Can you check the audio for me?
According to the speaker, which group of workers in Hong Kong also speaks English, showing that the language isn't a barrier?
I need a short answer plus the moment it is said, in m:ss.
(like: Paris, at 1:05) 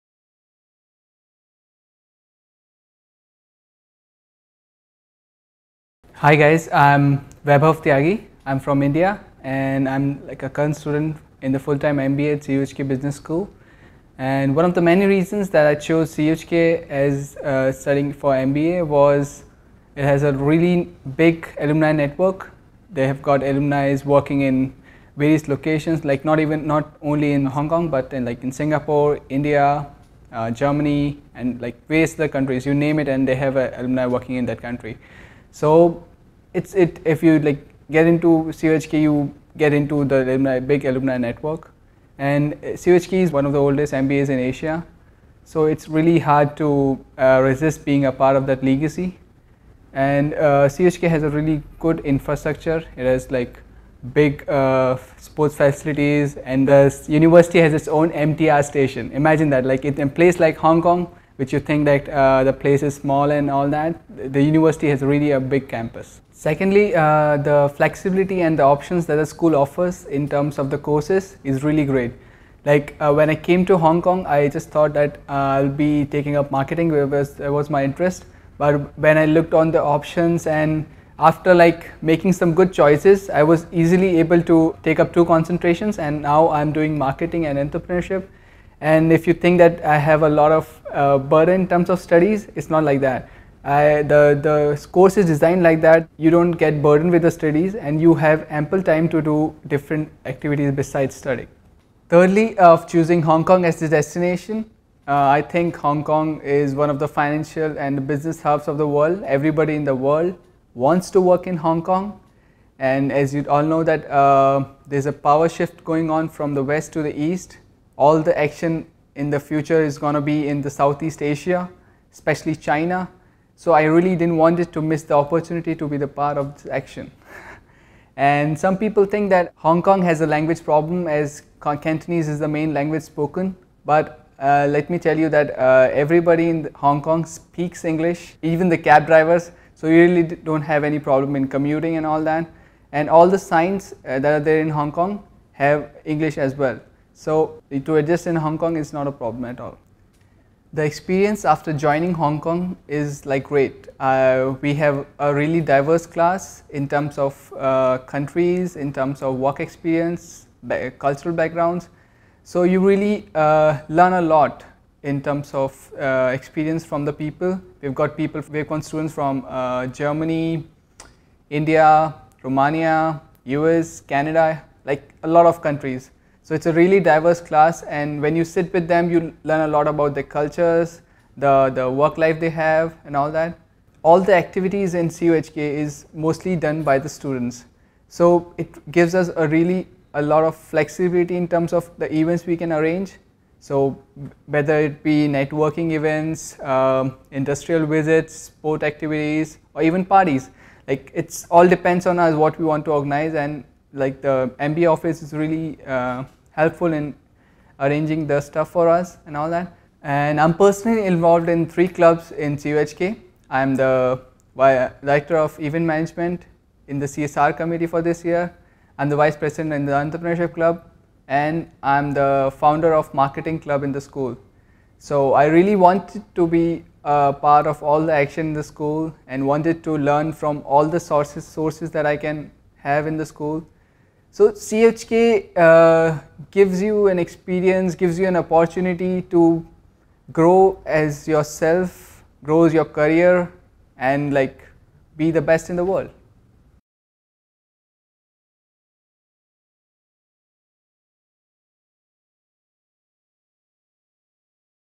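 Cab drivers, at 2:18.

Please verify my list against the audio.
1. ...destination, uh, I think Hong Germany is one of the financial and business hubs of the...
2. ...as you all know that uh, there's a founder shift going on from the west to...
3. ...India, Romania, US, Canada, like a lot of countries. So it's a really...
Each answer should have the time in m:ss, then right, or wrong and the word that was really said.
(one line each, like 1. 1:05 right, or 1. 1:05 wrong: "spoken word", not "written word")
1. 1:43 wrong: "Kong", not "Germany"
2. 1:53 wrong: "power", not "founder"
3. 2:51 right.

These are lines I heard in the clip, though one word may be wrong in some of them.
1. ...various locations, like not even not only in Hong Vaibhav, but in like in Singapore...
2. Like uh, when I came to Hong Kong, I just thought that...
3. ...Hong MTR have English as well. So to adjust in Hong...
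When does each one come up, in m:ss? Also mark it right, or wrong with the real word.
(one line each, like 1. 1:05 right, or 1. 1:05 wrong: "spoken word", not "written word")
1. 0:25 wrong: "Kong", not "Vaibhav"
2. 1:12 right
3. 2:24 wrong: "Kong", not "MTR".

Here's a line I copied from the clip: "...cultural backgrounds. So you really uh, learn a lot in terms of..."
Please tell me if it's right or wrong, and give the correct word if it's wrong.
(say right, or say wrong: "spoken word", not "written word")
right.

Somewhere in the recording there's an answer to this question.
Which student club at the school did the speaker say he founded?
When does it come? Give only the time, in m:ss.
3:43.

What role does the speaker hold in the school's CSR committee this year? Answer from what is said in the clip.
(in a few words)
Director of event management.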